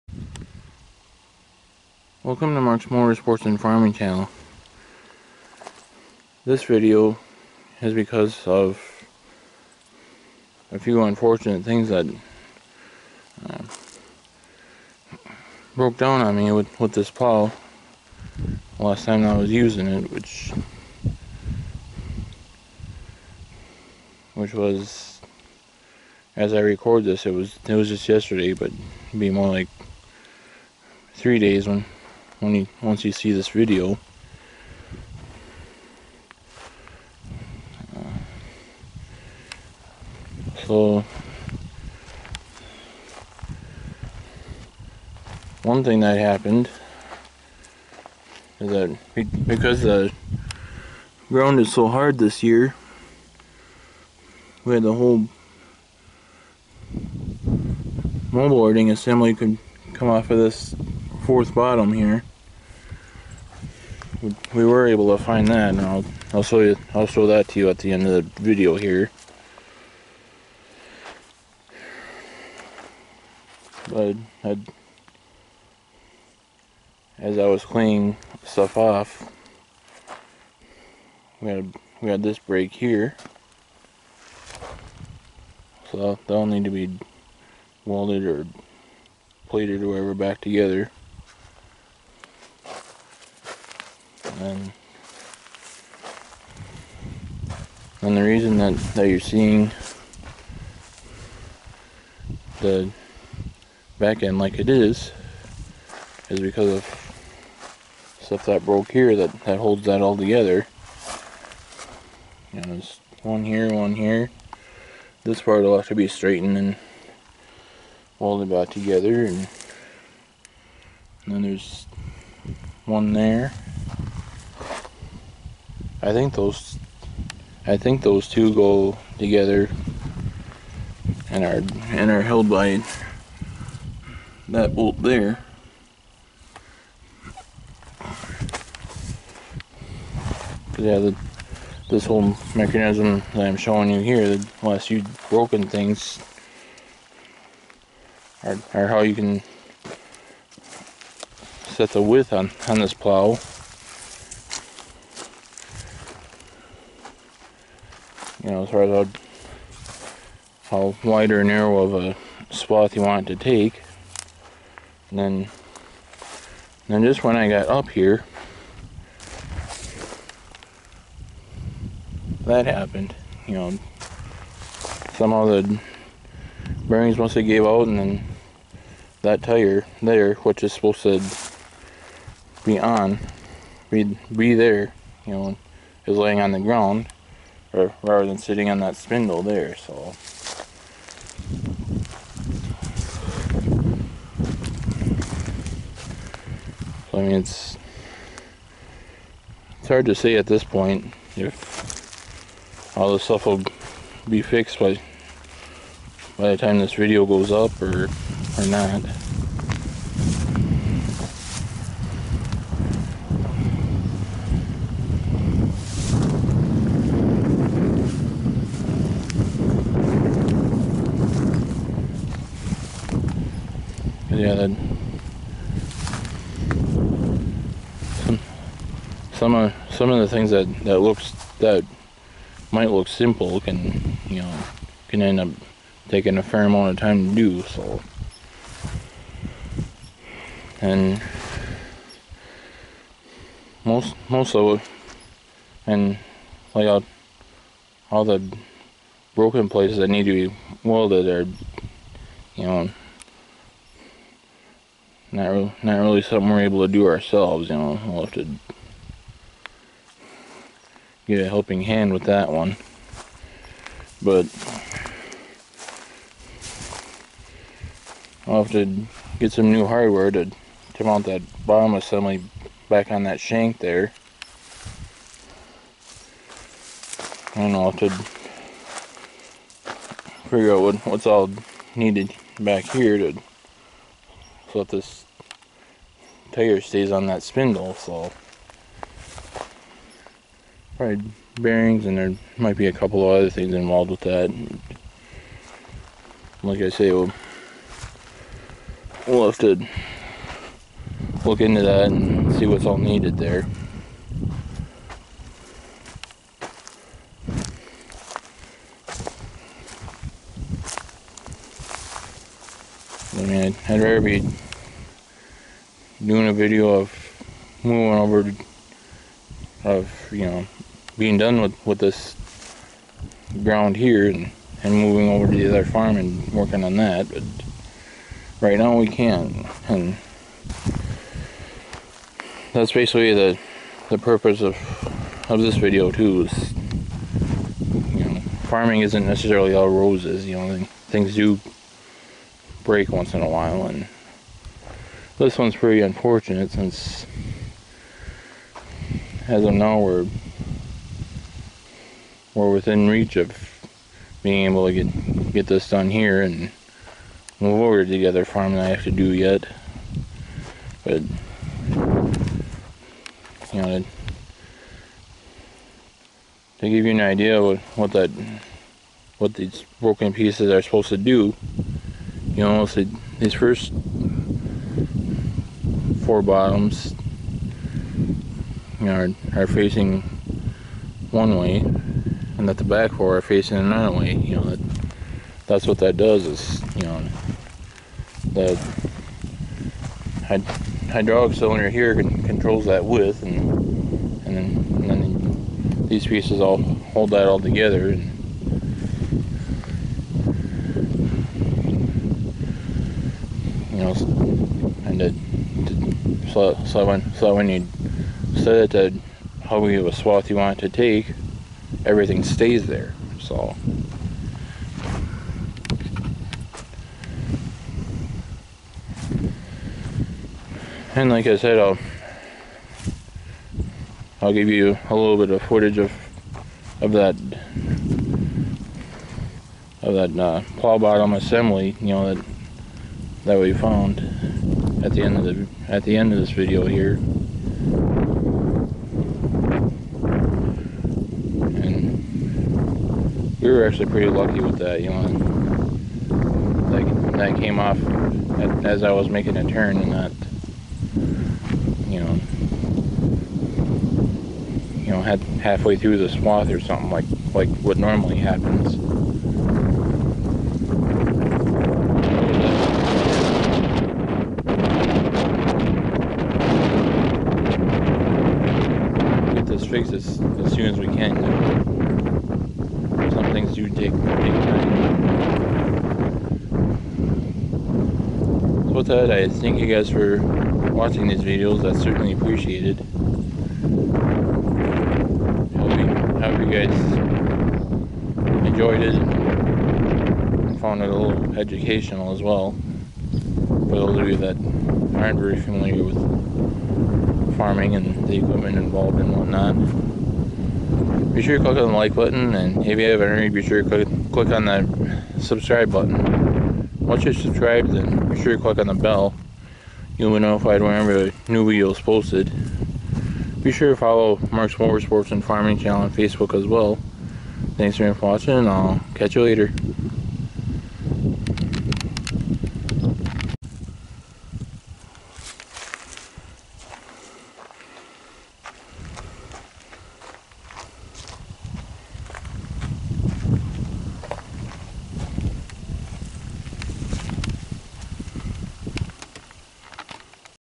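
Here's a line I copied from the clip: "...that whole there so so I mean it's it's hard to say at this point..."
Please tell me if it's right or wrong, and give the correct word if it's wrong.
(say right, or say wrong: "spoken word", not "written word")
wrong: "spindle", not "whole".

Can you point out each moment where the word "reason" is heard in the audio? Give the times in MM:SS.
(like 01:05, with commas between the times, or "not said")
01:38.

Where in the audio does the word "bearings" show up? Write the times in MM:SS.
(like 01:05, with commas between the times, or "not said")
02:56, 04:51.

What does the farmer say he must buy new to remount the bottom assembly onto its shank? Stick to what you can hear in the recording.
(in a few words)
hardware.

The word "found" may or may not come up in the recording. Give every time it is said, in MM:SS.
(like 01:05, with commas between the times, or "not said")
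07:13, 08:10.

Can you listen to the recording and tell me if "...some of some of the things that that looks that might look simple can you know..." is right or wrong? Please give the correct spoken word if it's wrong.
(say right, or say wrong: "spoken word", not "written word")
right.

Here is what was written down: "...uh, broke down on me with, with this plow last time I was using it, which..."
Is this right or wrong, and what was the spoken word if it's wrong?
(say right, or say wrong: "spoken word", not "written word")
right.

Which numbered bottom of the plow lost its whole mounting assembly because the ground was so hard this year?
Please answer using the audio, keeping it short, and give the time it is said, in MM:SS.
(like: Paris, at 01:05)
fourth, at 01:01.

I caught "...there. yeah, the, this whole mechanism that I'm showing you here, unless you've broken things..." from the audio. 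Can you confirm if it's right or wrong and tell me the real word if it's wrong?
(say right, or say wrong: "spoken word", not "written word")
right.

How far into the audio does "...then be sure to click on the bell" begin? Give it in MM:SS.
08:27.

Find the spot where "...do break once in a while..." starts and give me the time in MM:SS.
05:41.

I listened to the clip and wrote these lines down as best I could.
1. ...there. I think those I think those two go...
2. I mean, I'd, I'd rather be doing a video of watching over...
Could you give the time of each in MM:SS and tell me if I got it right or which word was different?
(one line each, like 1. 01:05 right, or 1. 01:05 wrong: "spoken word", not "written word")
1. 02:03 right
2. 05:13 wrong: "moving", not "watching".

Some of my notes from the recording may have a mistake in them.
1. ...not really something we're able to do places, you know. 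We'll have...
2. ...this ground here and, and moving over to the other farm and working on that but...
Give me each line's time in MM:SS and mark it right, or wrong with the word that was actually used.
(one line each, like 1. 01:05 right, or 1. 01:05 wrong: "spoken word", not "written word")
1. 04:15 wrong: "ourselves", not "places"
2. 05:21 right.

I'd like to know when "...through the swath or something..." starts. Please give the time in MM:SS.
07:35.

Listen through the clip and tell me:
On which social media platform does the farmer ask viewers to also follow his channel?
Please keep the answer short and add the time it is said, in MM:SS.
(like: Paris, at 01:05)
Facebook, at 08:36.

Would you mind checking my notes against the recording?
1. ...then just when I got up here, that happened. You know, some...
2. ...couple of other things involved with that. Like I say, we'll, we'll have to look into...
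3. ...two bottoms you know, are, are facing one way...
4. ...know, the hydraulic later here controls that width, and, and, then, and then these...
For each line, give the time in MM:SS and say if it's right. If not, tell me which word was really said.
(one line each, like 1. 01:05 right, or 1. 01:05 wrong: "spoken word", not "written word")
1. 02:46 right
2. 04:52 right
3. 06:16 wrong: "four", not "two"
4. 06:27 wrong: "cylinder", not "later".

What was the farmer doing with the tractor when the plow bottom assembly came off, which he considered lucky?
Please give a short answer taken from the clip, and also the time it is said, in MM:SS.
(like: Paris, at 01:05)
making a turn, at 07:29.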